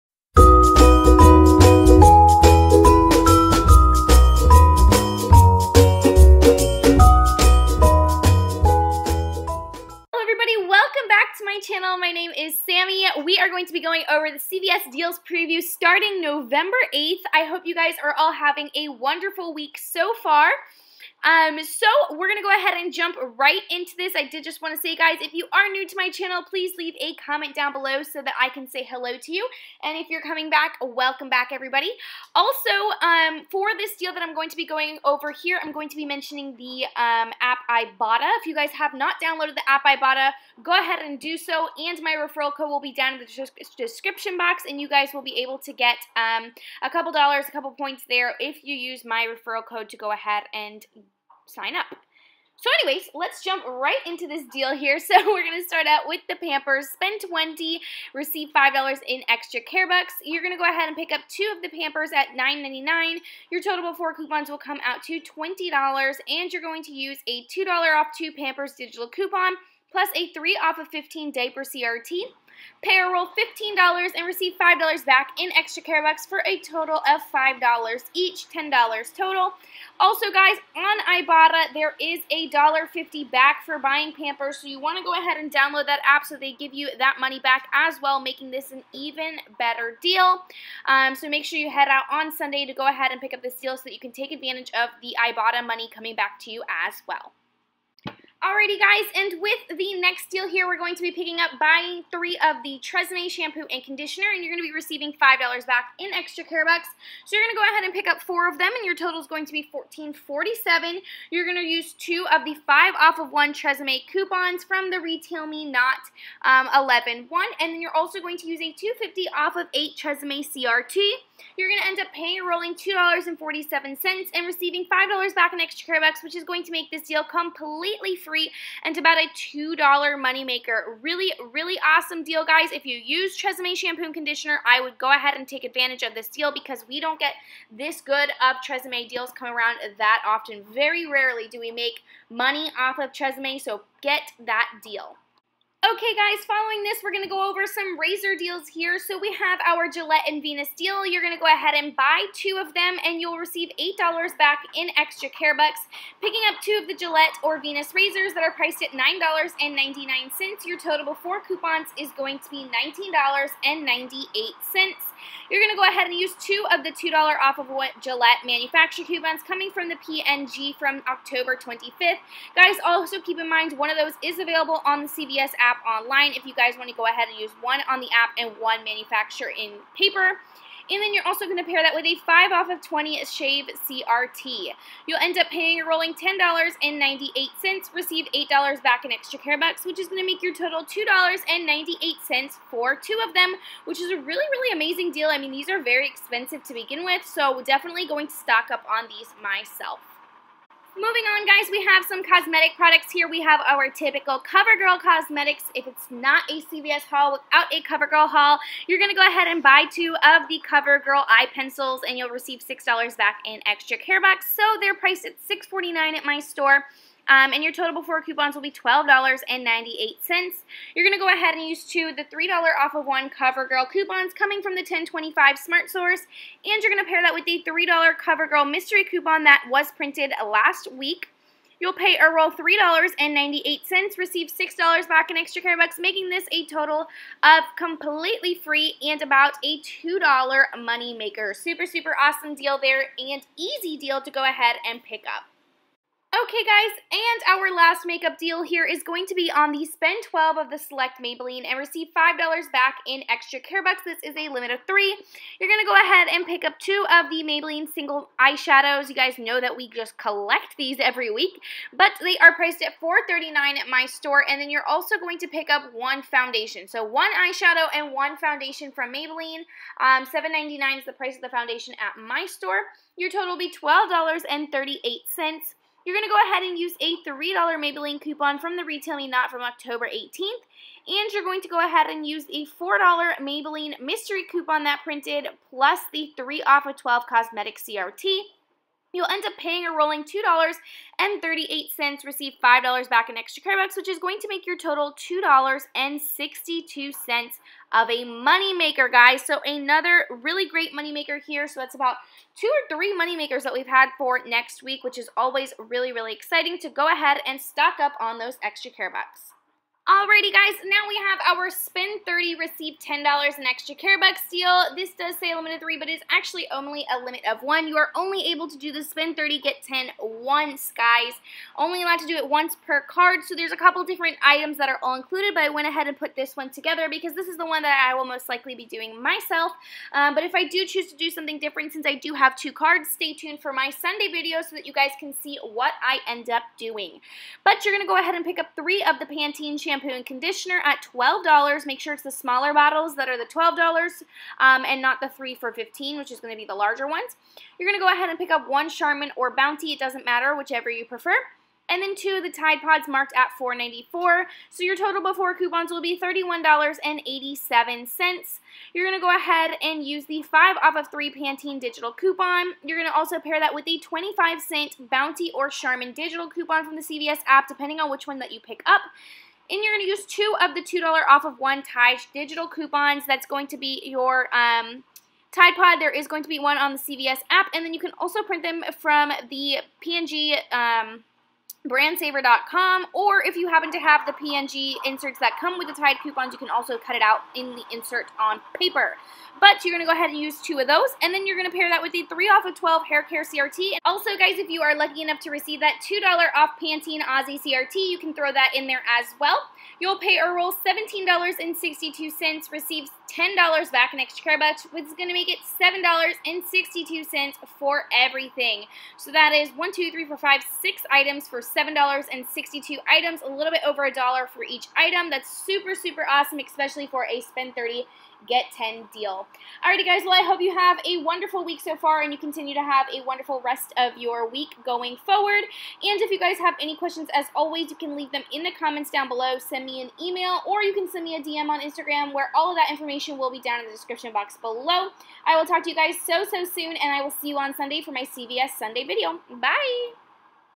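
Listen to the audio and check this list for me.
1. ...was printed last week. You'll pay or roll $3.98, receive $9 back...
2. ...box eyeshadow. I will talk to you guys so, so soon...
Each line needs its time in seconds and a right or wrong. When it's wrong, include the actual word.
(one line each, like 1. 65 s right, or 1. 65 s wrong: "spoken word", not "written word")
1. 229 s wrong: "6", not "9"
2. 434 s wrong: "below", not "eyeshadow".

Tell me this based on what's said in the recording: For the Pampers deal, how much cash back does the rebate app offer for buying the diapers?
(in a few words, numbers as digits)
$1.50.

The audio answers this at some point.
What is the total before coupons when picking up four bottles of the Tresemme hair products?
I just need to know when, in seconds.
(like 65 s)
109 s.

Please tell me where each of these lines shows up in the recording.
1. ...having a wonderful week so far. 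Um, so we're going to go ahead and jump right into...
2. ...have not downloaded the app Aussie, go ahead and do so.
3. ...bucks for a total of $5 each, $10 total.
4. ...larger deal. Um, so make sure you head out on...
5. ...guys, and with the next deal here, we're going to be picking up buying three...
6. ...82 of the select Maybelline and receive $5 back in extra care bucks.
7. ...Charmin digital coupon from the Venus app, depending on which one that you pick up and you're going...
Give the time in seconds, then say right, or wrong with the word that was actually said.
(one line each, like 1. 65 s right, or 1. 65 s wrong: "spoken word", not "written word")
1. 18 s right
2. 38 s wrong: "Ibotta", not "Aussie"
3. 76 s right
4. 89 s wrong: "better", not "larger"
5. 98 s right
6. 250 s wrong: "12", not "82"
7. 365 s wrong: "CVS", not "Venus".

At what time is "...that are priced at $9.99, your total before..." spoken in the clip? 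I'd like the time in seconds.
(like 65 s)
158 s.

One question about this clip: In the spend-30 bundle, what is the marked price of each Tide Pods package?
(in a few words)
$4.94.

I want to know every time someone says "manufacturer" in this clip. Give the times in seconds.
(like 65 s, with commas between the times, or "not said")
168 s, 178 s.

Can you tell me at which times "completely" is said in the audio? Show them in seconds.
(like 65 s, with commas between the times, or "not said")
127 s, 237 s.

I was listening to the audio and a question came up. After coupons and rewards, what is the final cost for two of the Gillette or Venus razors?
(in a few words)
$2.98.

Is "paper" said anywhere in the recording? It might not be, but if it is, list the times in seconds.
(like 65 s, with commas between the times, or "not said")
179 s, 388 s.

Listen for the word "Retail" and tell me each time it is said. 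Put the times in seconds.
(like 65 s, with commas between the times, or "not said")
114 s, 278 s.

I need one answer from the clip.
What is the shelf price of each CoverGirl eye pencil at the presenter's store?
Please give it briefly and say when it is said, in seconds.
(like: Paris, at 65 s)
$6.49, at 215 s.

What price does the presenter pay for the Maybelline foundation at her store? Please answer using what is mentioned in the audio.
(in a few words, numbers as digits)
$7.99.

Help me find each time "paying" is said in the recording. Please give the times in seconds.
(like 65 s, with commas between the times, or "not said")
122 s, 185 s, 289 s.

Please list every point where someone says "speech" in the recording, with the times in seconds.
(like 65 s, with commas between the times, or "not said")
not said.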